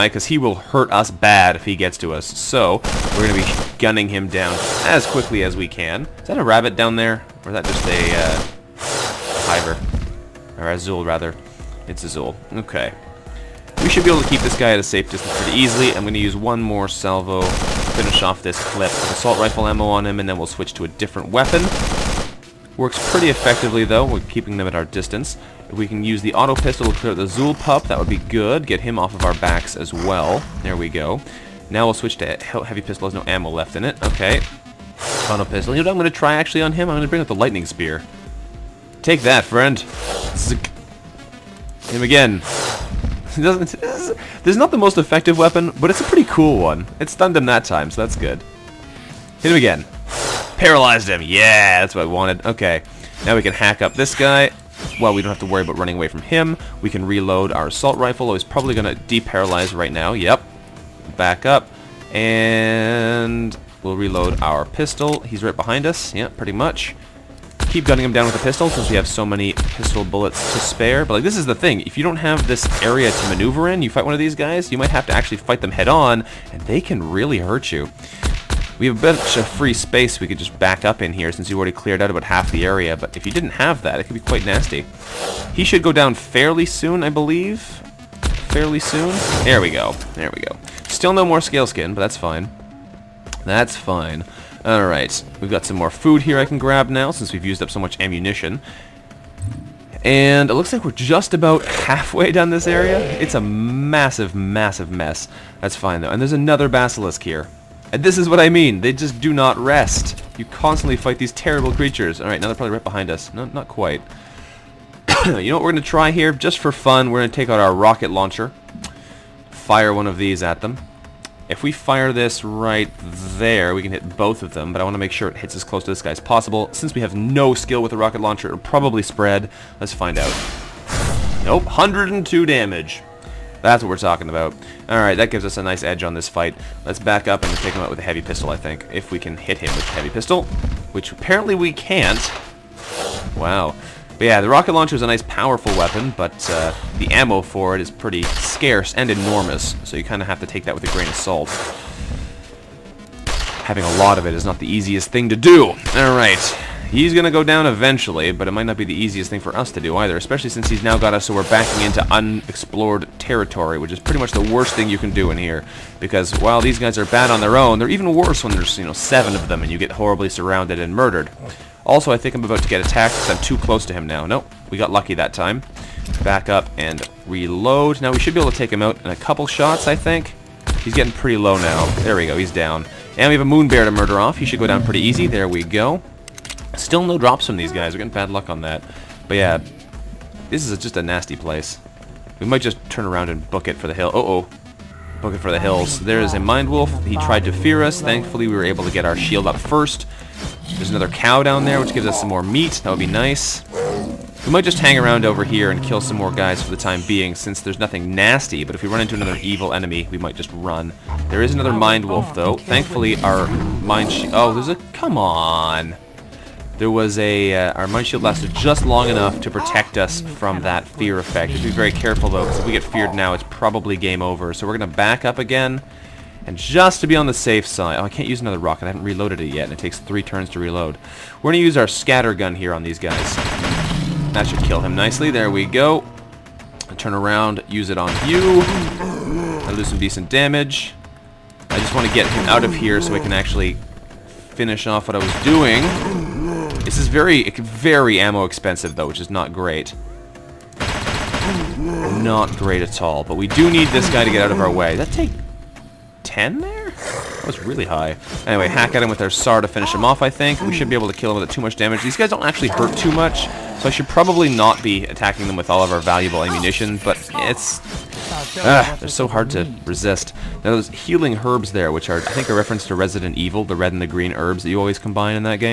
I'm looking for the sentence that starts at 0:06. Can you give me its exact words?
Is that a rabbit down there?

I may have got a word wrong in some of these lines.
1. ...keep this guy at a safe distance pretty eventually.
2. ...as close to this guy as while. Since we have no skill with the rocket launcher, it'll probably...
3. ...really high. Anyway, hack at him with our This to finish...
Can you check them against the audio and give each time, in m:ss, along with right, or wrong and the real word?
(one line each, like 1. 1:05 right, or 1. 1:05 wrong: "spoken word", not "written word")
1. 0:14 wrong: "easily", not "eventually"
2. 2:05 wrong: "possible", not "while"
3. 4:17 wrong: "SAR", not "This".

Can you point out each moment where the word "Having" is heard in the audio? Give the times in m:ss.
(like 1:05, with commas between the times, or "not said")
2:33.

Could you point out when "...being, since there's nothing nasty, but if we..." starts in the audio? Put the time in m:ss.
3:27.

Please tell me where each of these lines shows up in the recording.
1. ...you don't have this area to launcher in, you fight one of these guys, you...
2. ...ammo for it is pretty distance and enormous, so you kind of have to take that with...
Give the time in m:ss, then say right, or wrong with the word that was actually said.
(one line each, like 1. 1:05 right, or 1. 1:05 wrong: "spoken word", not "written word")
1. 1:11 wrong: "maneuver", not "launcher"
2. 2:27 wrong: "scarce", not "distance".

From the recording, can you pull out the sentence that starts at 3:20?
There's another cow down there, which gives us some more meat.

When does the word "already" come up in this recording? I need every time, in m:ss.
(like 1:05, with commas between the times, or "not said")
1:21.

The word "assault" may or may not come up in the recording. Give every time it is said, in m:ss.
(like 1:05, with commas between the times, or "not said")
0:18, 0:57.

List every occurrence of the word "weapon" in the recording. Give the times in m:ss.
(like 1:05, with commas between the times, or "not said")
0:21, 0:45, 2:25.